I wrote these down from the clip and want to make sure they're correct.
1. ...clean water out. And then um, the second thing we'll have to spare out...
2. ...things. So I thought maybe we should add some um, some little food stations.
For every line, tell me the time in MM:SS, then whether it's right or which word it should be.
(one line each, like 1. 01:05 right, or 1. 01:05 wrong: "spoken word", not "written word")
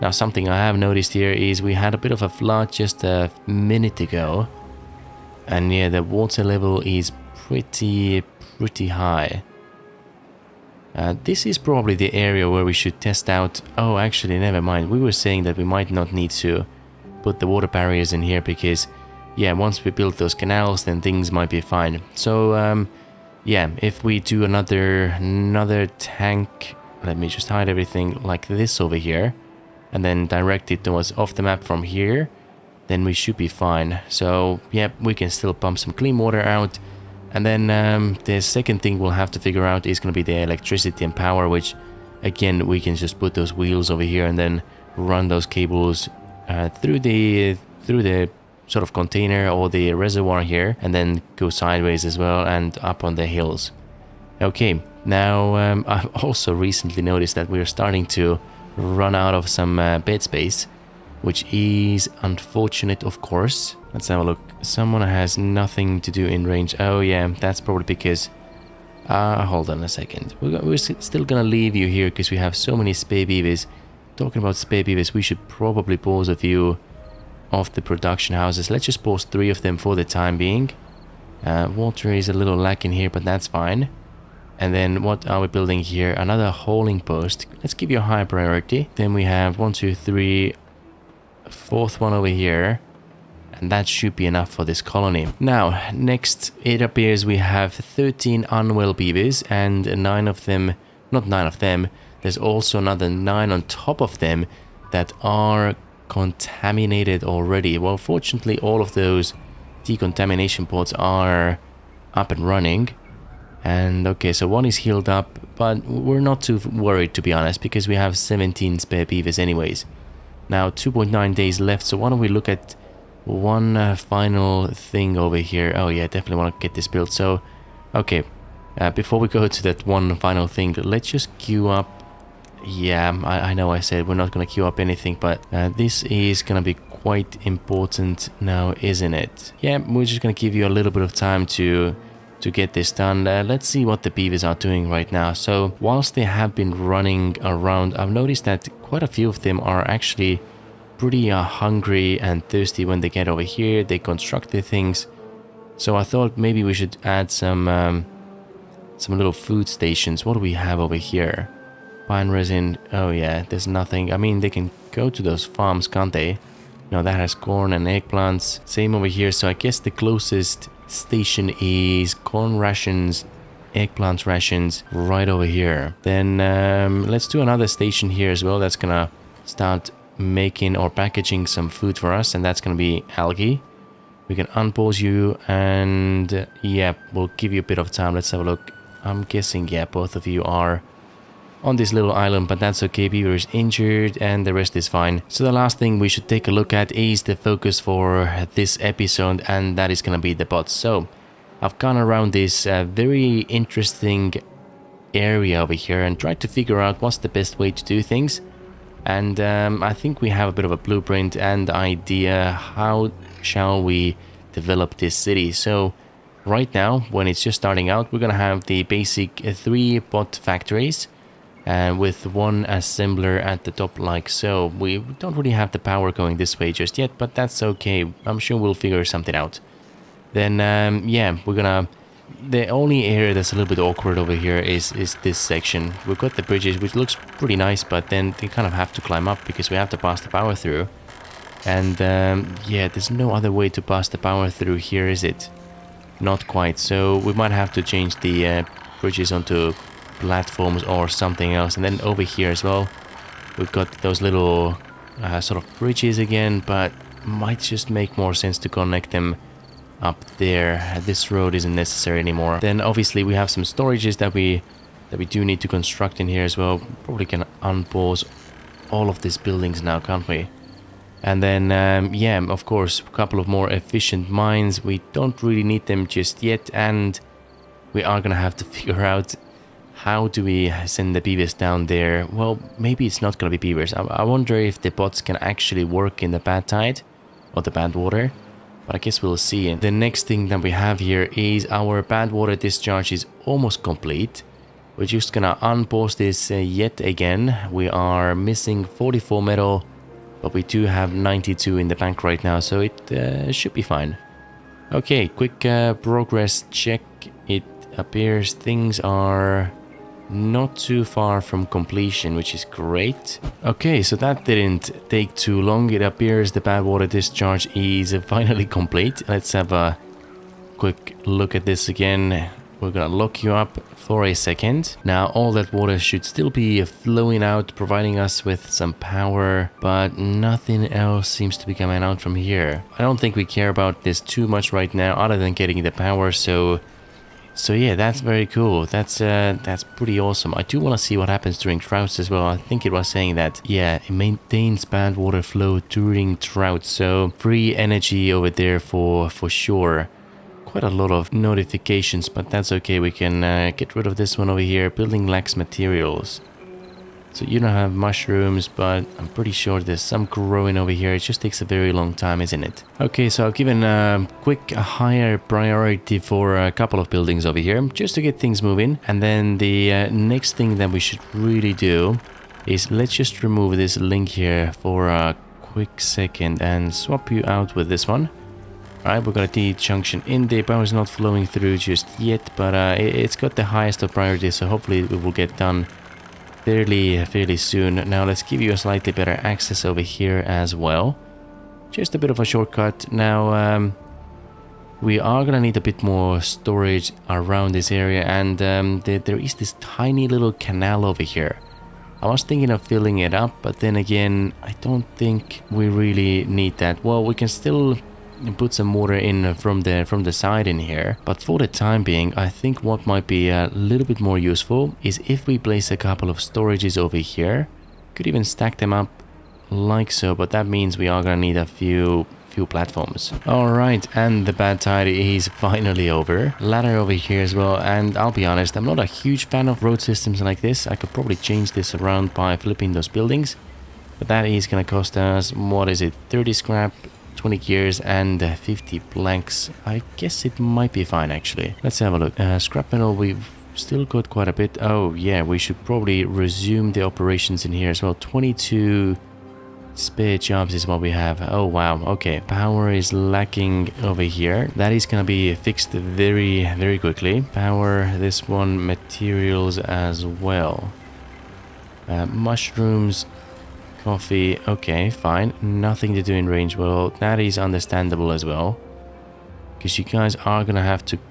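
1. 00:35 wrong: "figure", not "spare"
2. 02:34 right.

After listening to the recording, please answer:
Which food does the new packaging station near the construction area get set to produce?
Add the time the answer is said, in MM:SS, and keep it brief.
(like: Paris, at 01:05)
algae, at 03:03.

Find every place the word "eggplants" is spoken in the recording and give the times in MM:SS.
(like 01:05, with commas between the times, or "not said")
02:47, 02:53.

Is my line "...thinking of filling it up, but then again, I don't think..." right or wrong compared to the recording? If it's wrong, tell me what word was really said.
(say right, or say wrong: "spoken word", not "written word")
right.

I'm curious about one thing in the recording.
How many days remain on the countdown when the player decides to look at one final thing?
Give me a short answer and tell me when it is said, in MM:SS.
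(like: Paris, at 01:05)
2.9, at 02:00.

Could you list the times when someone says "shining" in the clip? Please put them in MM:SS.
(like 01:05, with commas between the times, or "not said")
not said.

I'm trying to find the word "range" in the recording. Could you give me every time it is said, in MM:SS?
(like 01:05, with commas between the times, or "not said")
01:06, 07:46.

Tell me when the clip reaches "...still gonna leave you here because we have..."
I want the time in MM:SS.
01:10.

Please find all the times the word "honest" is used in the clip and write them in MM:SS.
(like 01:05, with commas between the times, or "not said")
01:57, 07:08.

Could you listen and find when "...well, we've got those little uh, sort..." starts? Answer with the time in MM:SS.
04:12.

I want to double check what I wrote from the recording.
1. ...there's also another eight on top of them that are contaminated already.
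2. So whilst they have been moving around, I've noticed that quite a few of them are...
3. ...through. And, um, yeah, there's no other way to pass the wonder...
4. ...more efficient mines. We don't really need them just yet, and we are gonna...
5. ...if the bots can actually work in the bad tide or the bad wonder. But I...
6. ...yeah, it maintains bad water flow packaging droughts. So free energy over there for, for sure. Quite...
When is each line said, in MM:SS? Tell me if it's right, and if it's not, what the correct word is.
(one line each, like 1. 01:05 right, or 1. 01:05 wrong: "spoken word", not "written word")
1. 01:42 wrong: "nine", not "eight"
2. 02:25 wrong: "running", not "moving"
3. 04:00 wrong: "power", not "wonder"
4. 04:33 right
5. 04:44 wrong: "water", not "wonder"
6. 05:43 wrong: "during", not "packaging".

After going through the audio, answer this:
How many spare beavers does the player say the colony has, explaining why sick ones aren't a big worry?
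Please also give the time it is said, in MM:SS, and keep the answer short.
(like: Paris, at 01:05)
17, at 01:58.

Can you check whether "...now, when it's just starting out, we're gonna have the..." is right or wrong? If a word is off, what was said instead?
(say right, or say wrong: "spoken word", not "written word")
right.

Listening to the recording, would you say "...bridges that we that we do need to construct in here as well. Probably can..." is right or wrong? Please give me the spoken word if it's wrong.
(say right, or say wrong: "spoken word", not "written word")
wrong: "storages", not "bridges".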